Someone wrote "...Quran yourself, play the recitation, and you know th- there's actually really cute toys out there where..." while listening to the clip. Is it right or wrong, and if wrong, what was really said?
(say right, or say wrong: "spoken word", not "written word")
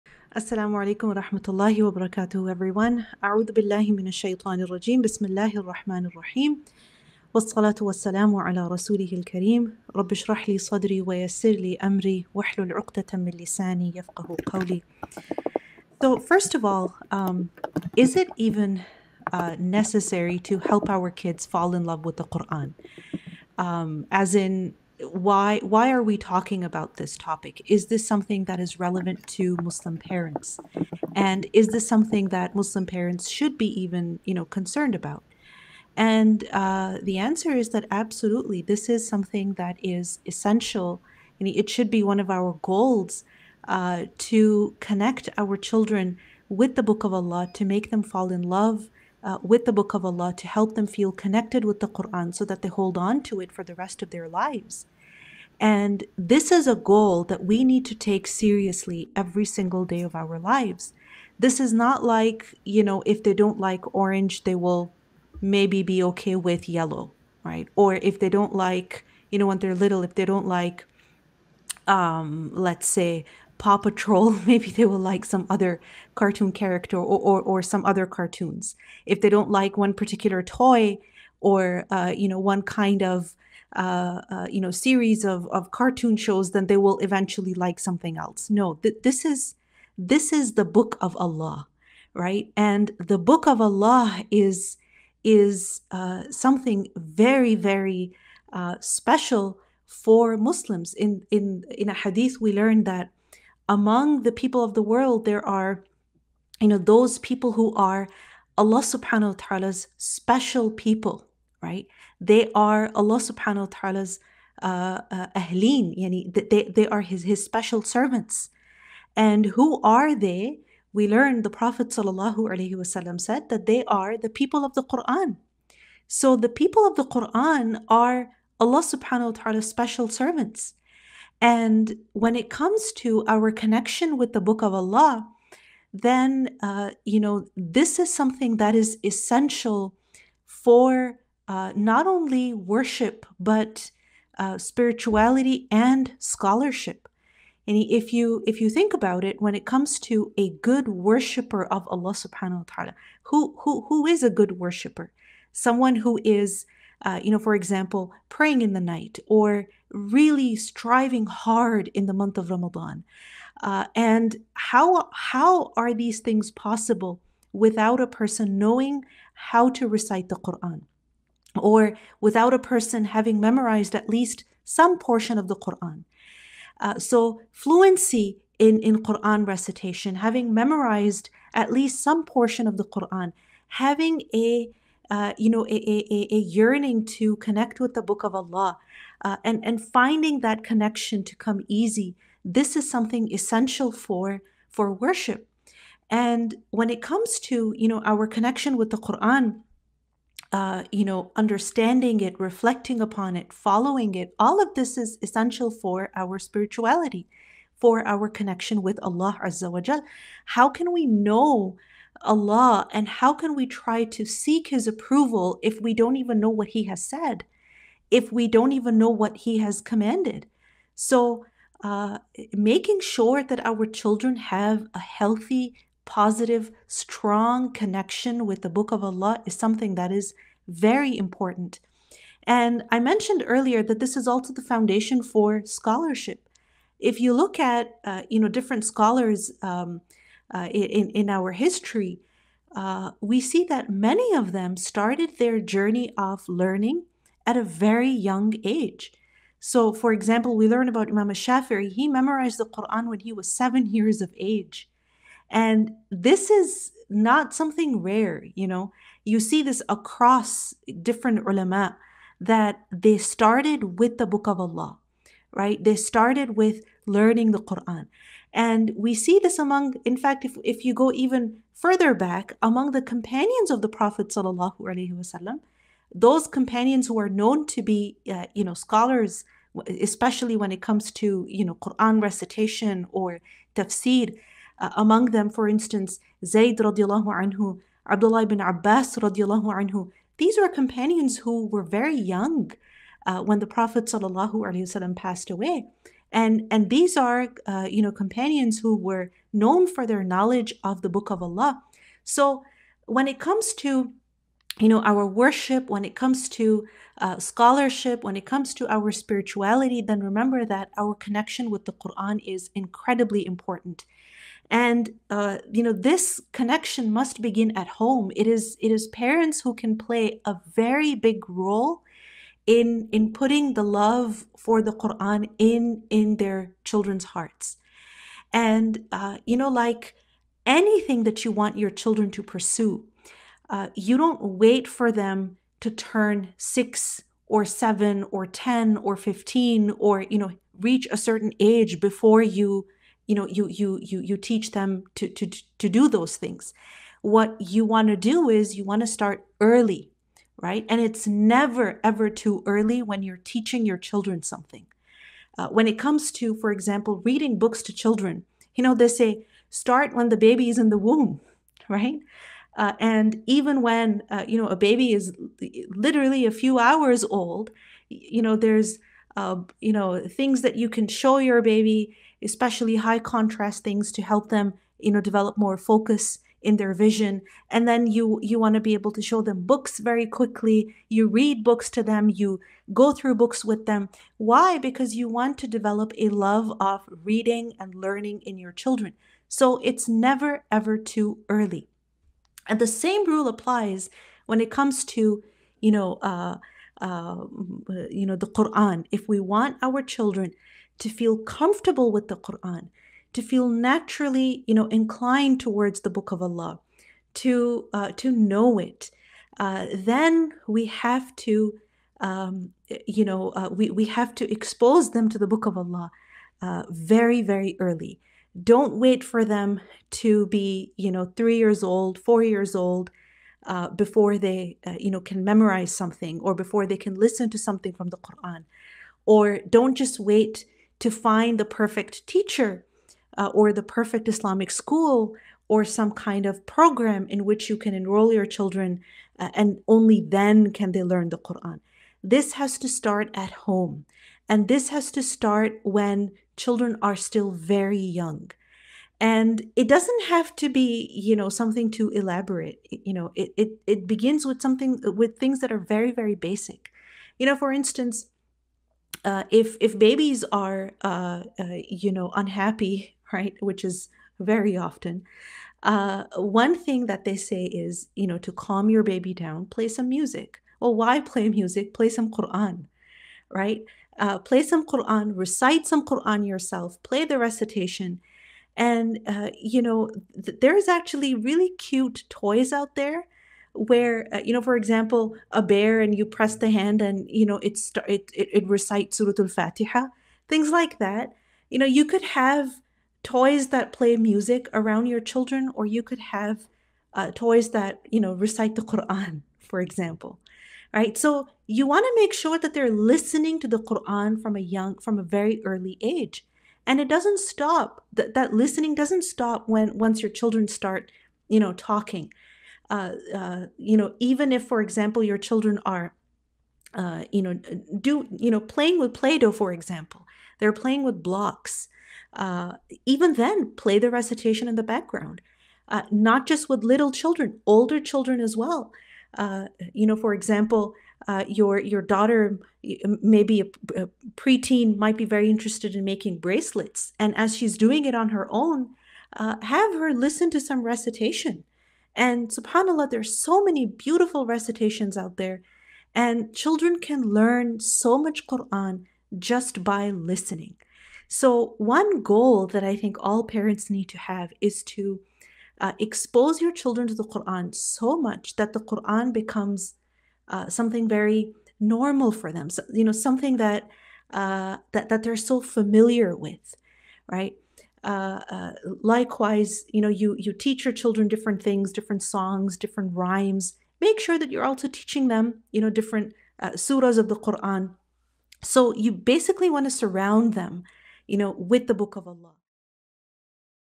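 right.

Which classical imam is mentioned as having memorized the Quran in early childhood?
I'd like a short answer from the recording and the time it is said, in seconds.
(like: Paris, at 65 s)
Imam Shafi'i, at 251 s.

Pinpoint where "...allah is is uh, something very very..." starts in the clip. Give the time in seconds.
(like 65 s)
93 s.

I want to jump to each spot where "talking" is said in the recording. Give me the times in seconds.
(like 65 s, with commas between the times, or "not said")
26 s, 511 s.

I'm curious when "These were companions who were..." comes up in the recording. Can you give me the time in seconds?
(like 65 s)
290 s.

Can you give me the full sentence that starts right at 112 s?
They are Allah subhanahu wa ta'ala's uh, uh, ahleen, yani they, they are his, his special servants.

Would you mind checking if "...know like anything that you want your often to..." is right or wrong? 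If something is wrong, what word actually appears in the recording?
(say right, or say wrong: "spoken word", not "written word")
wrong: "children", not "often".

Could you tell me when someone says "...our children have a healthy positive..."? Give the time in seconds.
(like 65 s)
223 s.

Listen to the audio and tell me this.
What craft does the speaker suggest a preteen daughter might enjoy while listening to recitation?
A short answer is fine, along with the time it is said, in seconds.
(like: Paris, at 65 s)
Making bracelets, at 536 s.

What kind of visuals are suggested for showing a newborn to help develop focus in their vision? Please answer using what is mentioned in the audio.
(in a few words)
High contrast things.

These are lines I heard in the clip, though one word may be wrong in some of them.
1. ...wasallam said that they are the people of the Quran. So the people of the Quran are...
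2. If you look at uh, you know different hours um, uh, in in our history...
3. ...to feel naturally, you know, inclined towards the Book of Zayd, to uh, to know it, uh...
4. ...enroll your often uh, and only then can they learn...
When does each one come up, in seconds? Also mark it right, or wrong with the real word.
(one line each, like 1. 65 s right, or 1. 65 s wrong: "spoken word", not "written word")
1. 121 s right
2. 236 s wrong: "scholars", not "hours"
3. 403 s wrong: "Allah", not "Zayd"
4. 437 s wrong: "children", not "often".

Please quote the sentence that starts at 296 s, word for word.
And, and these are uh, you know companions who were known for their knowledge of the book of Allah.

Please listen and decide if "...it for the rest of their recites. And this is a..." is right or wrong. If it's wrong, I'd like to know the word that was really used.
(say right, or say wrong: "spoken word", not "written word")
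wrong: "lives", not "recites".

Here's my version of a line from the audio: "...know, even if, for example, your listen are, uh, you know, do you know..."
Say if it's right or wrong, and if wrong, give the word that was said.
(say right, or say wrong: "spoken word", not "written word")
wrong: "children", not "listen".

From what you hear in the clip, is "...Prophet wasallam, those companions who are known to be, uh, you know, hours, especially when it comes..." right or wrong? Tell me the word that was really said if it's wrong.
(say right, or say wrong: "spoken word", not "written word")
wrong: "scholars", not "hours".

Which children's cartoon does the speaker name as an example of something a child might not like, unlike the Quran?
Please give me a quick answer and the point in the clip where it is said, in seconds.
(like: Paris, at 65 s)
Paw Patrol, at 73 s.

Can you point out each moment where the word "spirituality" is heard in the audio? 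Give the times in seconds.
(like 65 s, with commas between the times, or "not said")
144 s, 206 s, 309 s.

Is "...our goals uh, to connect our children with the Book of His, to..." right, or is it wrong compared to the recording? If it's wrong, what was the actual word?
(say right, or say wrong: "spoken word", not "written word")
wrong: "Allah", not "His".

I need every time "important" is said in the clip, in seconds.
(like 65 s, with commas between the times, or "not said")
231 s, 313 s.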